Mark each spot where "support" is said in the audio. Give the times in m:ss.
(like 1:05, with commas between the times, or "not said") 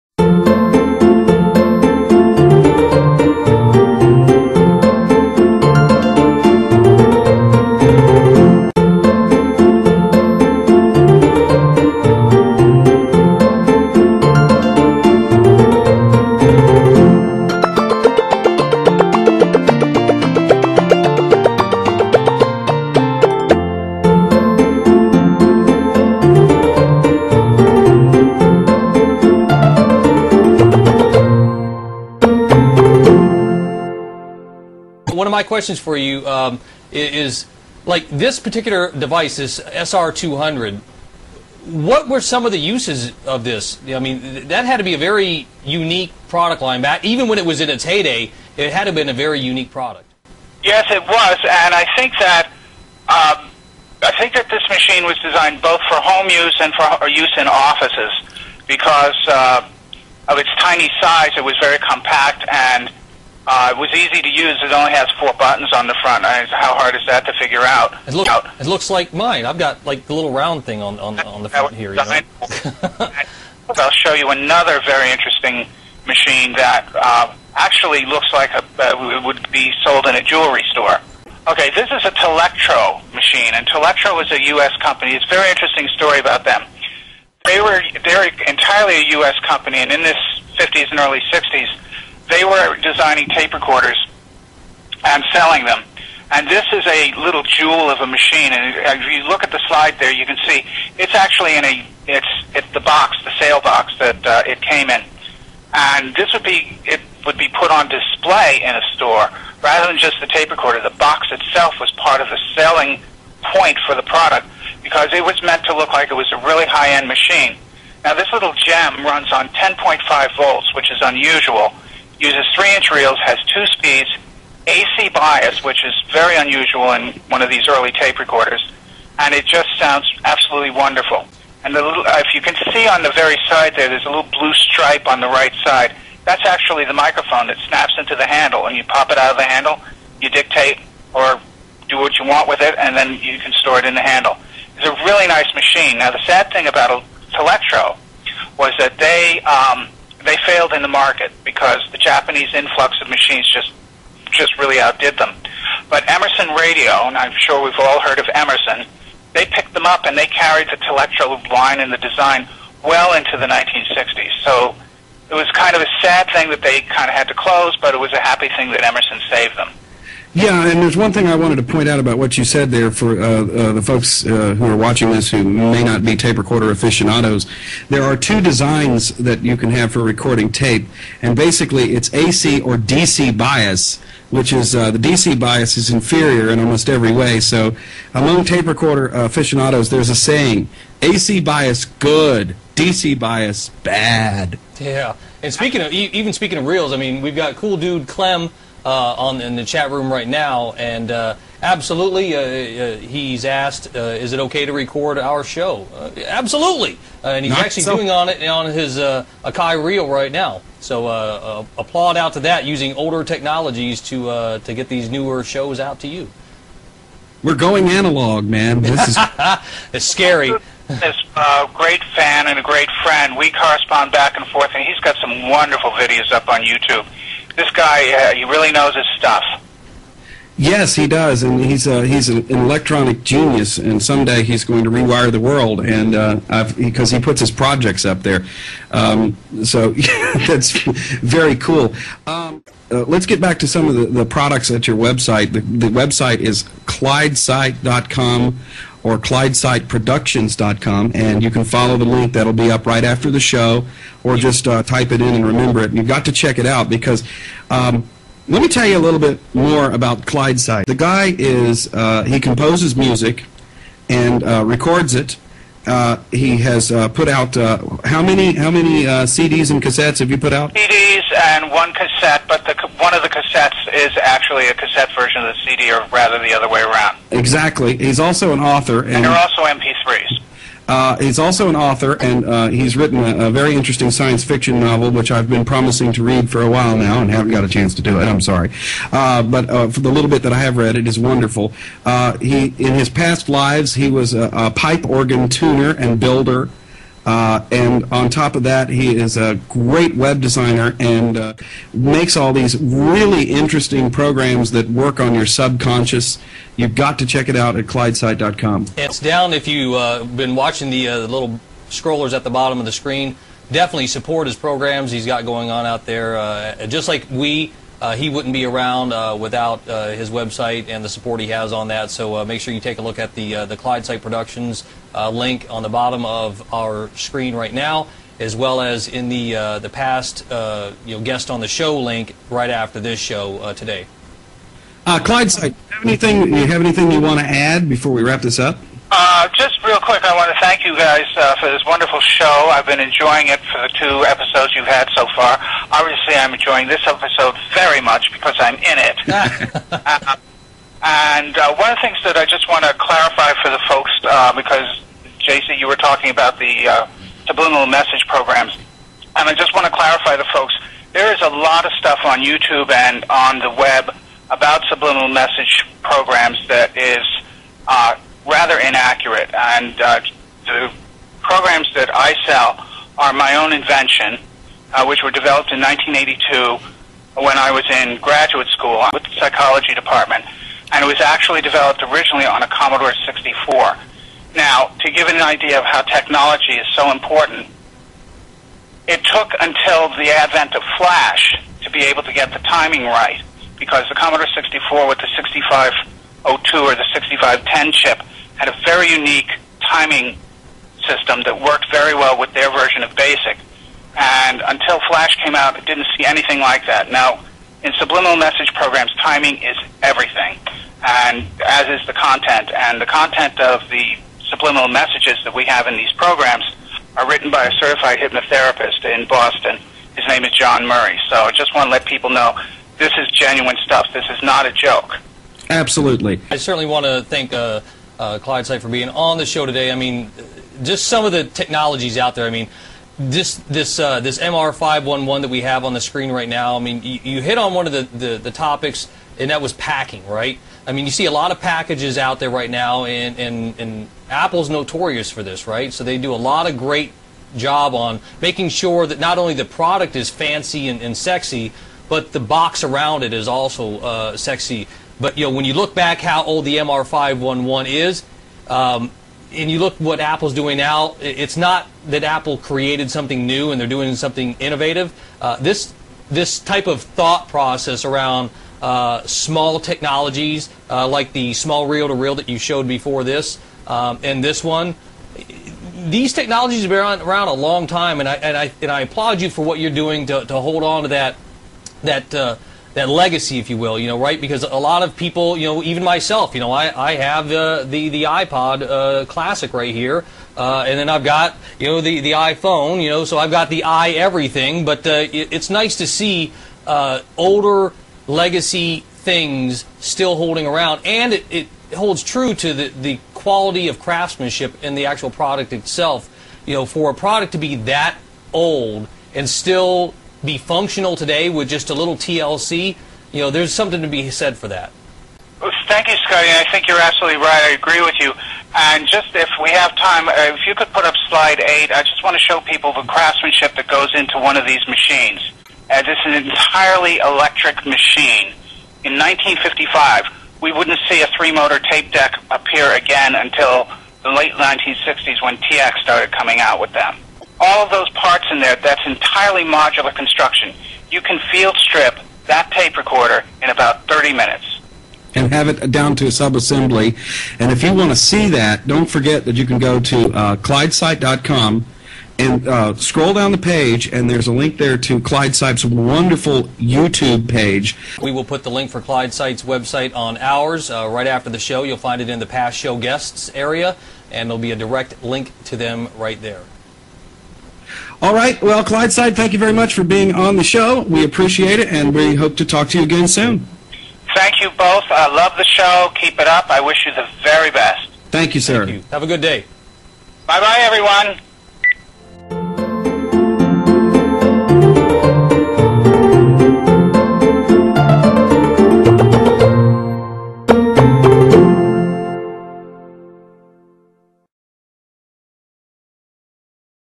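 5:14, 5:21.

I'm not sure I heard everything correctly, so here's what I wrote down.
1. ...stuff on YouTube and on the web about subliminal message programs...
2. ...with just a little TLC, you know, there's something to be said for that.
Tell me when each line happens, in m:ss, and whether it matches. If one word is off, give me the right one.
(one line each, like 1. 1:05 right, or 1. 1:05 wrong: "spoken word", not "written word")
1. 6:01 right
2. 8:31 right.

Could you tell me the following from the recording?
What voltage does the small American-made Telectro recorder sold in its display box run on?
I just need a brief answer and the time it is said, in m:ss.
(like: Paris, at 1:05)
10.5 volts, at 1:59.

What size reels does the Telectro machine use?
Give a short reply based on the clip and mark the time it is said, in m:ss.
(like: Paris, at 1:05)
3-inch, at 2:02.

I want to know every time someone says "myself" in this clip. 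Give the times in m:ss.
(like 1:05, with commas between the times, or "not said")
8:06.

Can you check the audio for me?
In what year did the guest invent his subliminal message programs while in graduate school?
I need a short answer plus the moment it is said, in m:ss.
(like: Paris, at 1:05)
1982, at 6:15.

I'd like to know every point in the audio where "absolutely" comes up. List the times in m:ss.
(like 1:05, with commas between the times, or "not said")
2:10, 3:21, 3:26, 7:05, 8:36.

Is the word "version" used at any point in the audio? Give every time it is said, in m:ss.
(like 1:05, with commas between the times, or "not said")
4:35, 6:42.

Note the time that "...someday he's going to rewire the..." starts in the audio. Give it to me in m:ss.
3:54.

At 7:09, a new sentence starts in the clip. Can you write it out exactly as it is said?
I mean, just some of the technologies out there.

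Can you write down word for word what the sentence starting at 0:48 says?
It had to have been a very unique product.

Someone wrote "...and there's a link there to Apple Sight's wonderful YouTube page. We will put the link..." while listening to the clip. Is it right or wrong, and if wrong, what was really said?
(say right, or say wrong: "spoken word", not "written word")
wrong: "Clyde", not "Apple".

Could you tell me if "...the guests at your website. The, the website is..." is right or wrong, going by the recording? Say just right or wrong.
wrong.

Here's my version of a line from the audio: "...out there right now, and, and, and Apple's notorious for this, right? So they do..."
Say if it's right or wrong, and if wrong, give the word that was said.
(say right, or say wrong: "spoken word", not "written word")
right.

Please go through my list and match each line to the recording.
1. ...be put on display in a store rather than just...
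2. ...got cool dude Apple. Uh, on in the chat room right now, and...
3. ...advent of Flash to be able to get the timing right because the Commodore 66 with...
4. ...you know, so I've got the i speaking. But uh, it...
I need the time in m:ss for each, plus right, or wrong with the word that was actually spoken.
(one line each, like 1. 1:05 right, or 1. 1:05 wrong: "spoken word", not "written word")
1. 1:47 right
2. 3:17 wrong: "Clem", not "Apple"
3. 6:30 wrong: "64", not "66"
4. 8:13 wrong: "everything", not "speaking".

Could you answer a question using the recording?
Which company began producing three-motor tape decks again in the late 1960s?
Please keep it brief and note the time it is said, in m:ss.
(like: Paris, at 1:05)
TEAC, at 8:55.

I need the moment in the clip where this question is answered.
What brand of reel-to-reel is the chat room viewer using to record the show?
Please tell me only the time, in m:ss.
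3:28.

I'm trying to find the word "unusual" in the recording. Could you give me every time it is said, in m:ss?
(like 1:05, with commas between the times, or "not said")
2:01, 2:06.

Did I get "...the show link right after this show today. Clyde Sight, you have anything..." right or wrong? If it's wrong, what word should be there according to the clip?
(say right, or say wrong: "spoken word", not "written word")
right.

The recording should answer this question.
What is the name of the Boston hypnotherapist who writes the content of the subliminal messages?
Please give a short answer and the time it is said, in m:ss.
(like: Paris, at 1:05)
John Murray, at 7:00.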